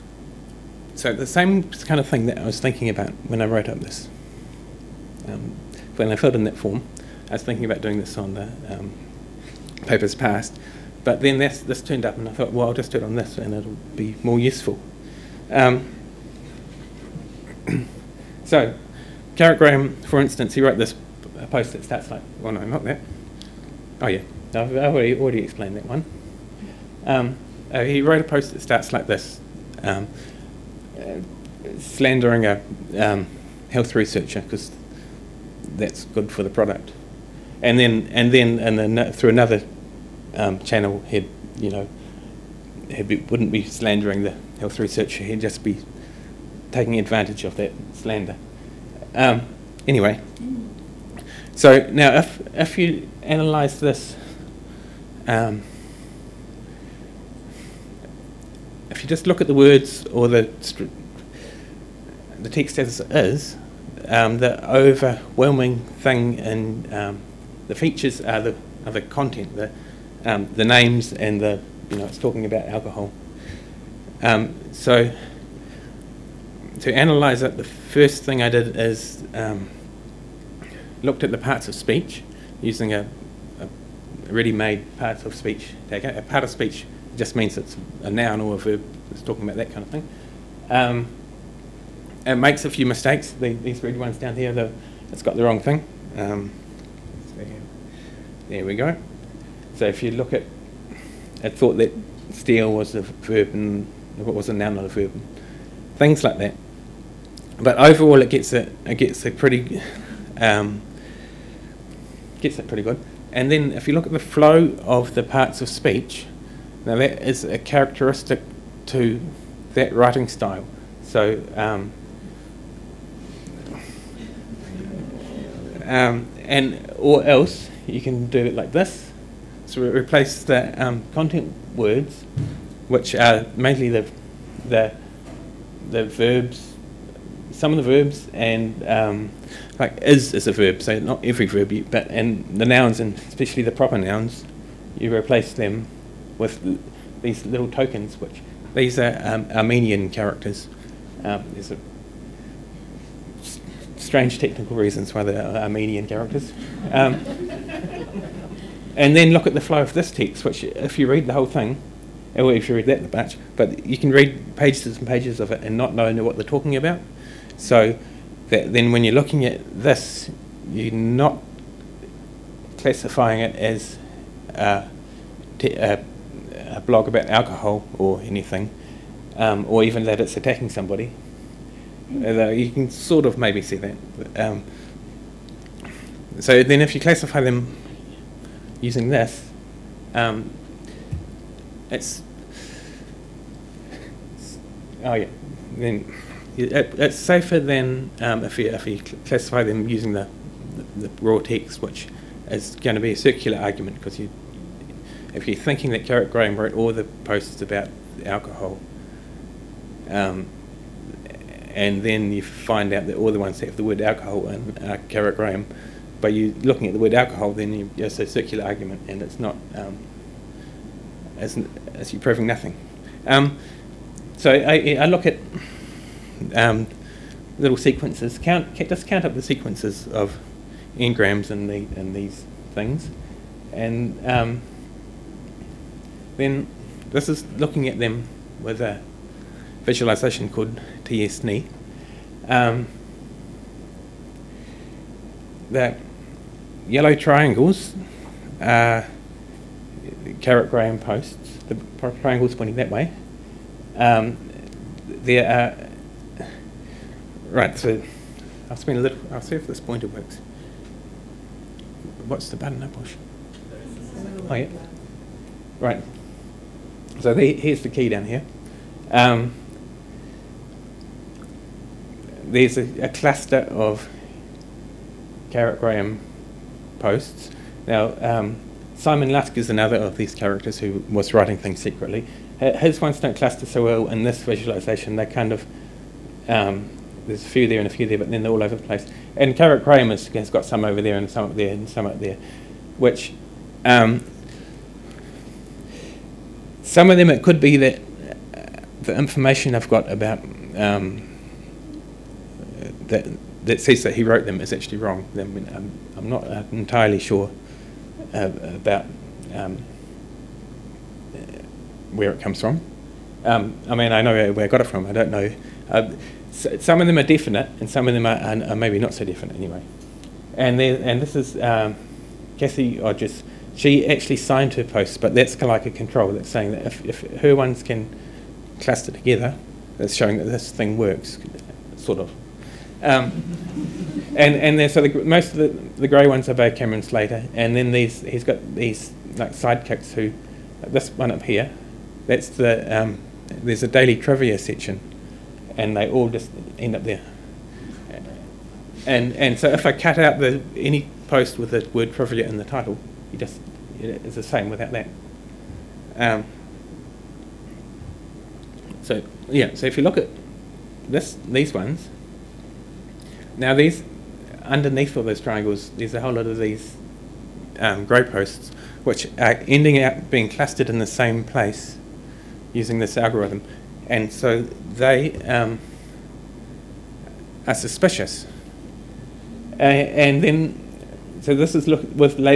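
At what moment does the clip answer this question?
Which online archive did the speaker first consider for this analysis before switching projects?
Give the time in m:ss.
0:09.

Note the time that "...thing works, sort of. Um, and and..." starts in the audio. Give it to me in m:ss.
5:30.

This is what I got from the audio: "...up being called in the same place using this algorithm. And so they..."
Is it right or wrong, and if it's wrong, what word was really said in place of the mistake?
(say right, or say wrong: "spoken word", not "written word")
wrong: "clustered", not "called".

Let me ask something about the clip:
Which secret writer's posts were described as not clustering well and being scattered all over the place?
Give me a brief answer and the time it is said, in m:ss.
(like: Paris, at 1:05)
Simon Lusk, at 4:38.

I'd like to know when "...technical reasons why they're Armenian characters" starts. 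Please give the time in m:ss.
2:34.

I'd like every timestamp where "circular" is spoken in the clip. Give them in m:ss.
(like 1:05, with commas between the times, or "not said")
3:23, 3:38.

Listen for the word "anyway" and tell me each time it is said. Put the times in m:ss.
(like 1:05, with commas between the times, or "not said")
0:49, 5:19.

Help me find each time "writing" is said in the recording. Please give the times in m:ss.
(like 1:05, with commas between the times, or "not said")
1:59, 4:41.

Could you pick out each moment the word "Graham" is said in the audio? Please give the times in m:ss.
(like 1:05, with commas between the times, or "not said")
0:19, 3:26, 3:35, 4:10, 4:35, 4:49.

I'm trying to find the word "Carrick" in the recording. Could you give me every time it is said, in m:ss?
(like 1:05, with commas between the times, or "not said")
3:26, 3:35, 4:10, 4:35, 4:49.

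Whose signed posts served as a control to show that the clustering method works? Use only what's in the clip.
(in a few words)
Cathy Odgers.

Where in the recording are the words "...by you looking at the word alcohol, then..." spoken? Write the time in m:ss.
3:36.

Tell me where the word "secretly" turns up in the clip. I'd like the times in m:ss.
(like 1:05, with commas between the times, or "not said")
4:41.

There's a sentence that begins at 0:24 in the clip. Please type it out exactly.
Oh, yeah, I've already, already explained that one.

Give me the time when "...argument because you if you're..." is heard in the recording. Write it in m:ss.
3:23.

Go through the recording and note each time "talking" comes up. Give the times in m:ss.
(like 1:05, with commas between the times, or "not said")
1:12, 1:29, 2:46.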